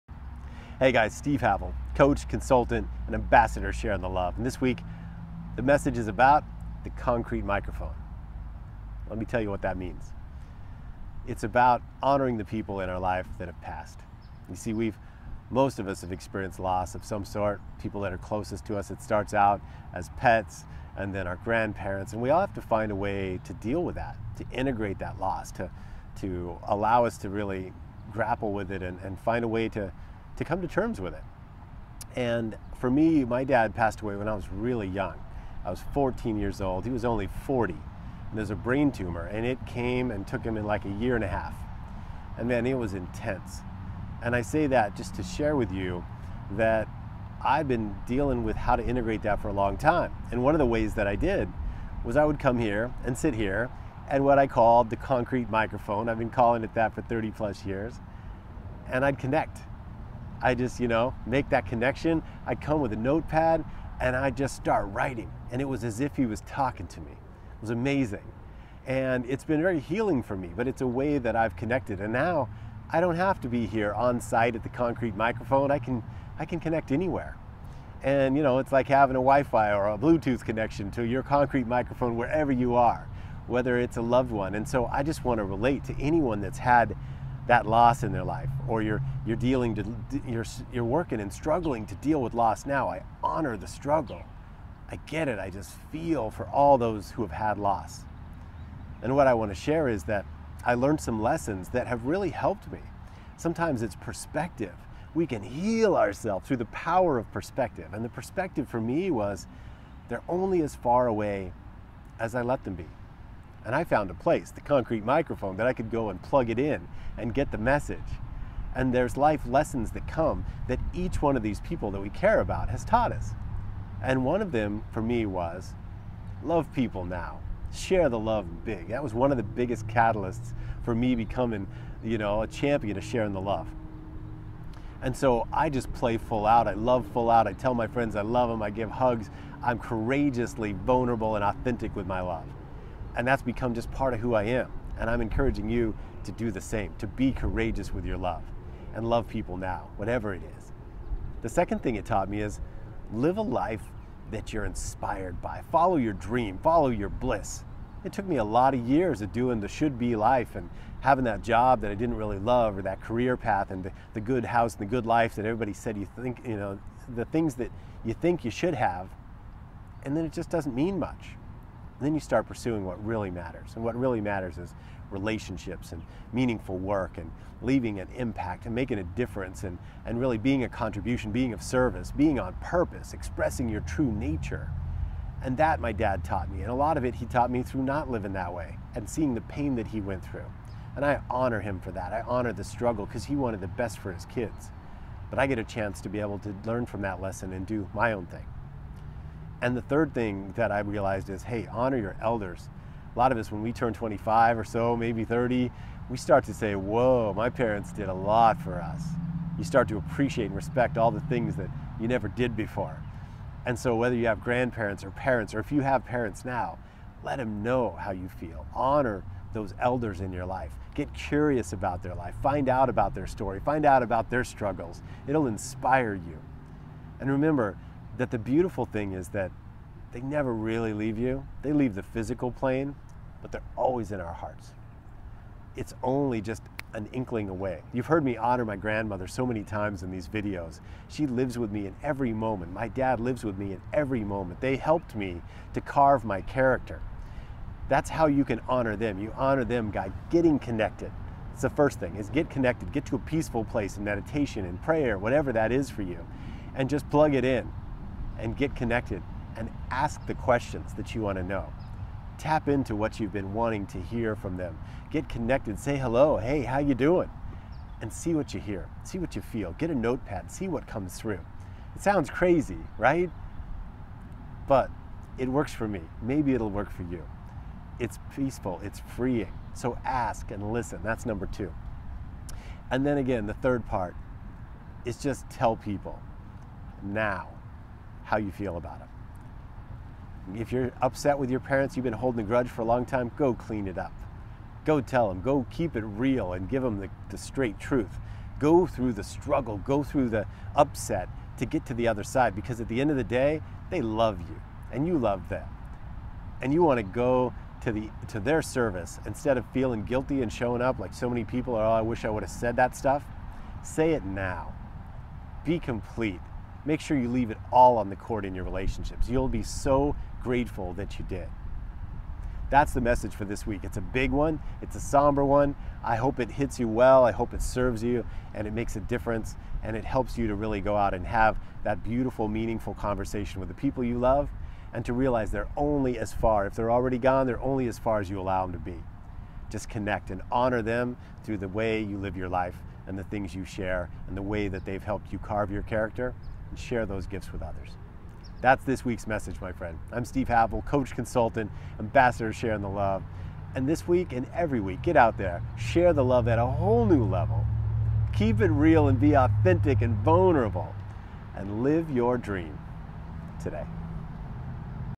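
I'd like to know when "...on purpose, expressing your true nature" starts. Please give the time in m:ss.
3:02.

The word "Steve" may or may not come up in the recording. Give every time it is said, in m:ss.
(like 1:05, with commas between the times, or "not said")
0:01, 5:50.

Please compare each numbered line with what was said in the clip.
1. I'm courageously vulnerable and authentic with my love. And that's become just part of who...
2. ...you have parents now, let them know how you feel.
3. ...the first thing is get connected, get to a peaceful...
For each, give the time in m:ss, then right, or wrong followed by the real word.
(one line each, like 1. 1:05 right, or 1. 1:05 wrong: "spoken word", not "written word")
1. 2:19 right
2. 3:35 right
3. 4:11 right.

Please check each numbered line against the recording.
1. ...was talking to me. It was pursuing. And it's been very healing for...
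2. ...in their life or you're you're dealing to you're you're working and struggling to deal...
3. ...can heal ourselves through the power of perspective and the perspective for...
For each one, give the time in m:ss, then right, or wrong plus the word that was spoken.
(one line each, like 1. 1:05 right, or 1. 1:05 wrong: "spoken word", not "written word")
1. 1:06 wrong: "amazing", not "pursuing"
2. 1:28 right
3. 1:45 right.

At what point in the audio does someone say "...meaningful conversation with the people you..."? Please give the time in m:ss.
5:32.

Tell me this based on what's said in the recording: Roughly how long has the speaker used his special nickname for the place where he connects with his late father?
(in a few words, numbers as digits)
30 plus years.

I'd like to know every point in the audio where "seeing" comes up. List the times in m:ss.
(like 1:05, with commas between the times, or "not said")
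3:09.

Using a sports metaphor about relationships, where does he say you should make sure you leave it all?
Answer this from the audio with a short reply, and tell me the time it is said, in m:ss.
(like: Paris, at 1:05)
on the court, at 5:17.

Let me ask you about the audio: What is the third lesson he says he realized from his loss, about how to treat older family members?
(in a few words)
honor your elders.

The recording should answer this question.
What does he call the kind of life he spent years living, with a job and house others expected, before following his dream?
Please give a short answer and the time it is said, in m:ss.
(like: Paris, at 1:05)
the should be life, at 2:39.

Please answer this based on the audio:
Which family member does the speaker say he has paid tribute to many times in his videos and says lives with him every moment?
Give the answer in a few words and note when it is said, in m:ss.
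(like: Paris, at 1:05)
grandmother, at 3:58.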